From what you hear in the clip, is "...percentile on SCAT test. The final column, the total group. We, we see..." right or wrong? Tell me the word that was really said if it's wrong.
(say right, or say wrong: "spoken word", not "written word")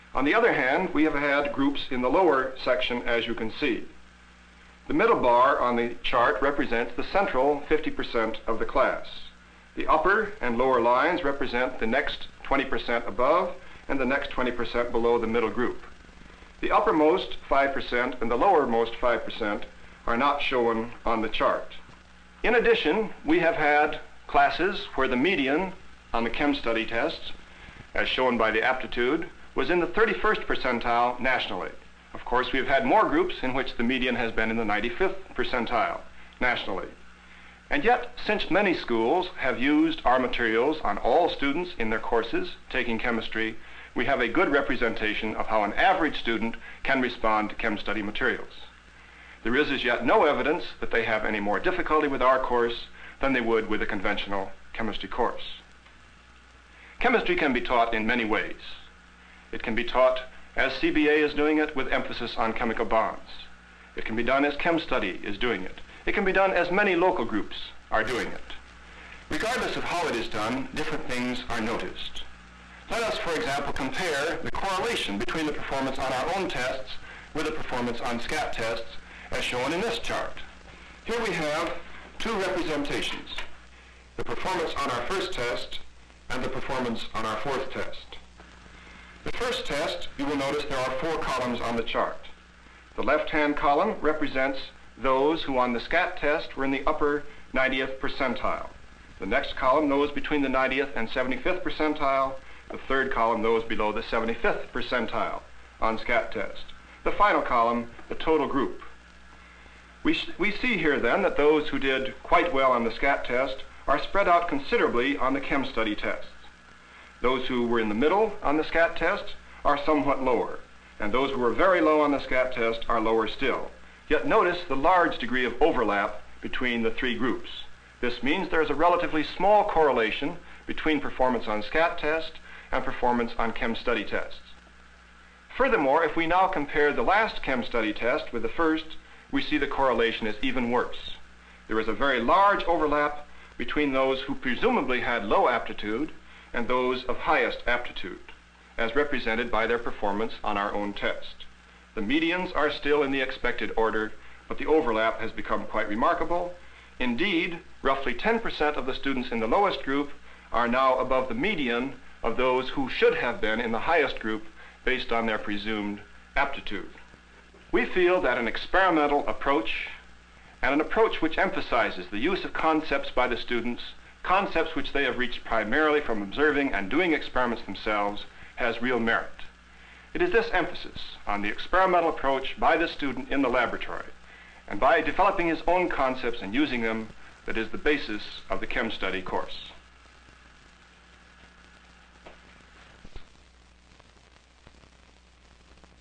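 right.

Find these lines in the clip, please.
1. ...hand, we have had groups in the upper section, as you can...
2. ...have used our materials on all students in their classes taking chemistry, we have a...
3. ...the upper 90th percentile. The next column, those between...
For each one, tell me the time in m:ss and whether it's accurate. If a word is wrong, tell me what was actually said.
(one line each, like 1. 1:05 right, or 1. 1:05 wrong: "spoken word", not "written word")
1. 0:00 wrong: "lower", not "upper"
2. 0:39 wrong: "courses", not "classes"
3. 1:36 right.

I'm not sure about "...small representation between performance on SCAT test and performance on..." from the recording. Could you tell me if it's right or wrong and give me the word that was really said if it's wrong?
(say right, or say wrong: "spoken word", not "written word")
wrong: "correlation", not "representation".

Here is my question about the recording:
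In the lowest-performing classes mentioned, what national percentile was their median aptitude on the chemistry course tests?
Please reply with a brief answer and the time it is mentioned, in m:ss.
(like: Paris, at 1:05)
31st, at 0:29.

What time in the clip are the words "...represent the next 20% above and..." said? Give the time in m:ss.
0:11.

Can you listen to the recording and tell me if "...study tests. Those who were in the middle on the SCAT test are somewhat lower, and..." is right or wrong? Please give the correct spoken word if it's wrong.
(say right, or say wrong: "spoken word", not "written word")
right.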